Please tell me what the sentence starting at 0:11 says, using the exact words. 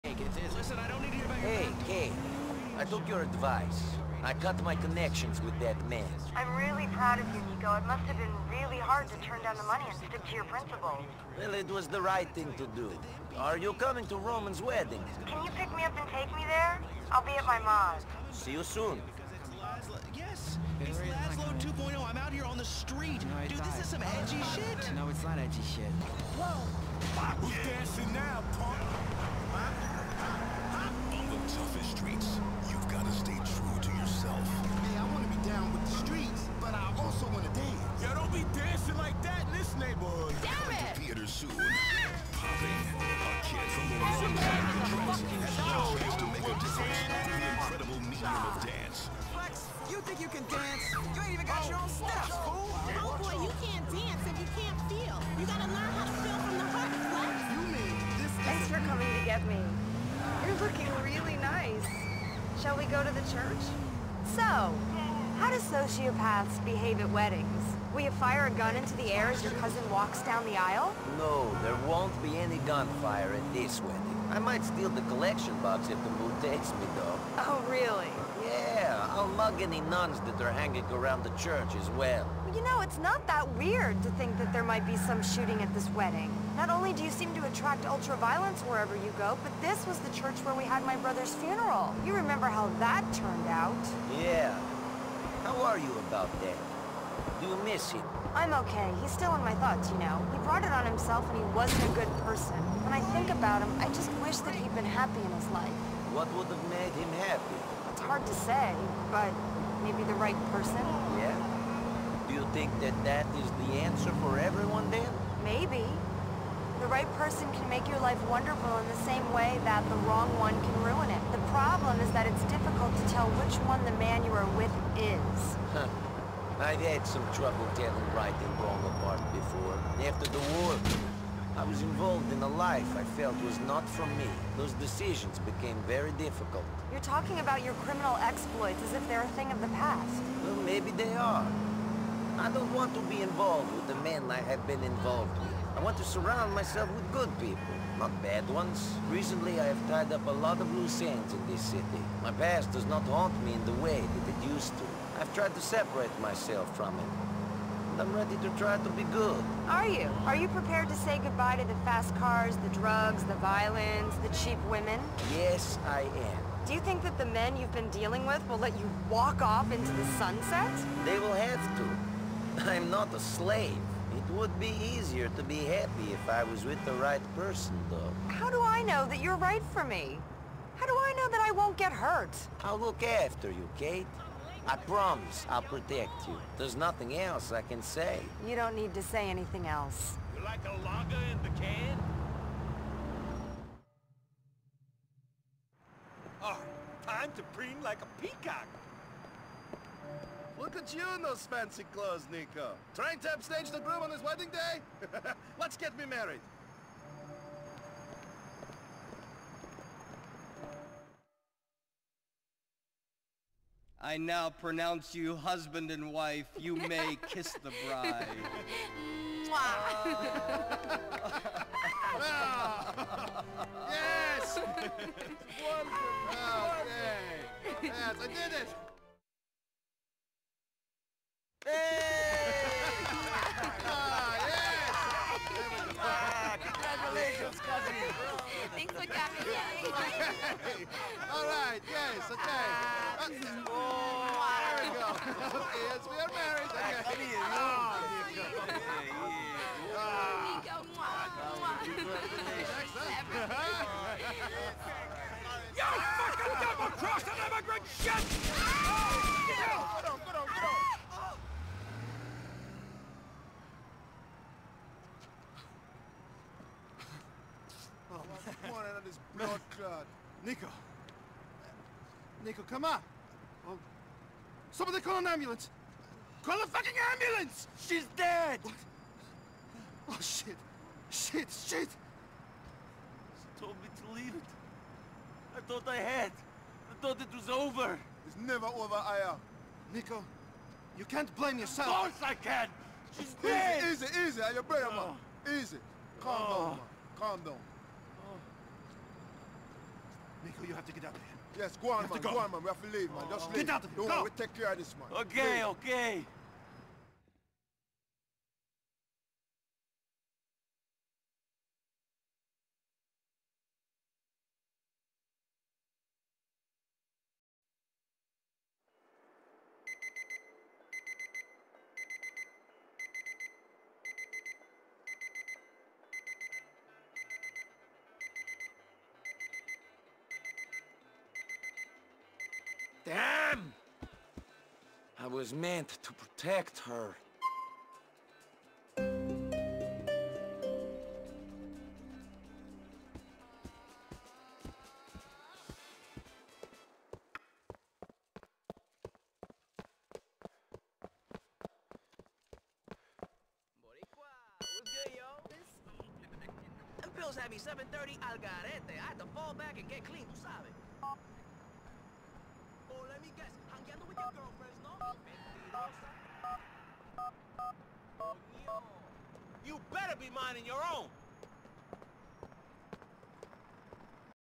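Well, it was the right thing to do.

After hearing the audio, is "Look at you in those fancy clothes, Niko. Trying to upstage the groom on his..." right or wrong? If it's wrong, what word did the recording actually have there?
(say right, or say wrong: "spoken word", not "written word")
right.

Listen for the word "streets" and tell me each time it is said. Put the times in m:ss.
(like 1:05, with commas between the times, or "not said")
0:22, 0:31, 0:36.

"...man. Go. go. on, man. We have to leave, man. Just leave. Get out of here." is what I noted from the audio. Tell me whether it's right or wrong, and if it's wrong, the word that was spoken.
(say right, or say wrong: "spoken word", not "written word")
right.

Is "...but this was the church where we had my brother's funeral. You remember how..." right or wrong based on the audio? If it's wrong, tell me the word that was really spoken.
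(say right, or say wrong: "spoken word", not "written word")
right.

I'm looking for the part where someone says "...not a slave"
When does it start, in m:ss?
2:52.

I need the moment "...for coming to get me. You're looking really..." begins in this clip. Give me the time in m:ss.
0:58.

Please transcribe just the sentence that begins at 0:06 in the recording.
I'm really proud of you, Niko.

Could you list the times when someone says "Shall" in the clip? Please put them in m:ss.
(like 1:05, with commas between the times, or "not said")
1:02.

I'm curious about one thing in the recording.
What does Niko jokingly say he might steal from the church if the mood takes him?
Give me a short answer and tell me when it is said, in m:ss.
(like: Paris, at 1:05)
The collection box, at 1:15.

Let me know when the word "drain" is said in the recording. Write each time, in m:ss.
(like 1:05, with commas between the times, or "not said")
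not said.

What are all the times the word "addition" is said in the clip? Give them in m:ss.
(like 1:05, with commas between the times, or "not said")
not said.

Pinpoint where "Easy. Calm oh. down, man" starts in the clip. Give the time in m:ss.
4:55.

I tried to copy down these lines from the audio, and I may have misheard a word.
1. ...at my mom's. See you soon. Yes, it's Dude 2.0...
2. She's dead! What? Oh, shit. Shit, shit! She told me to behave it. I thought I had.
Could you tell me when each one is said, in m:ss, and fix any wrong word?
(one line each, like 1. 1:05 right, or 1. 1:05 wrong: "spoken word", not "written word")
1. 0:17 wrong: "Laszlo", not "Dude"
2. 4:37 wrong: "leave", not "behave".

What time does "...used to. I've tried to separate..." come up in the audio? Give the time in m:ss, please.
2:34.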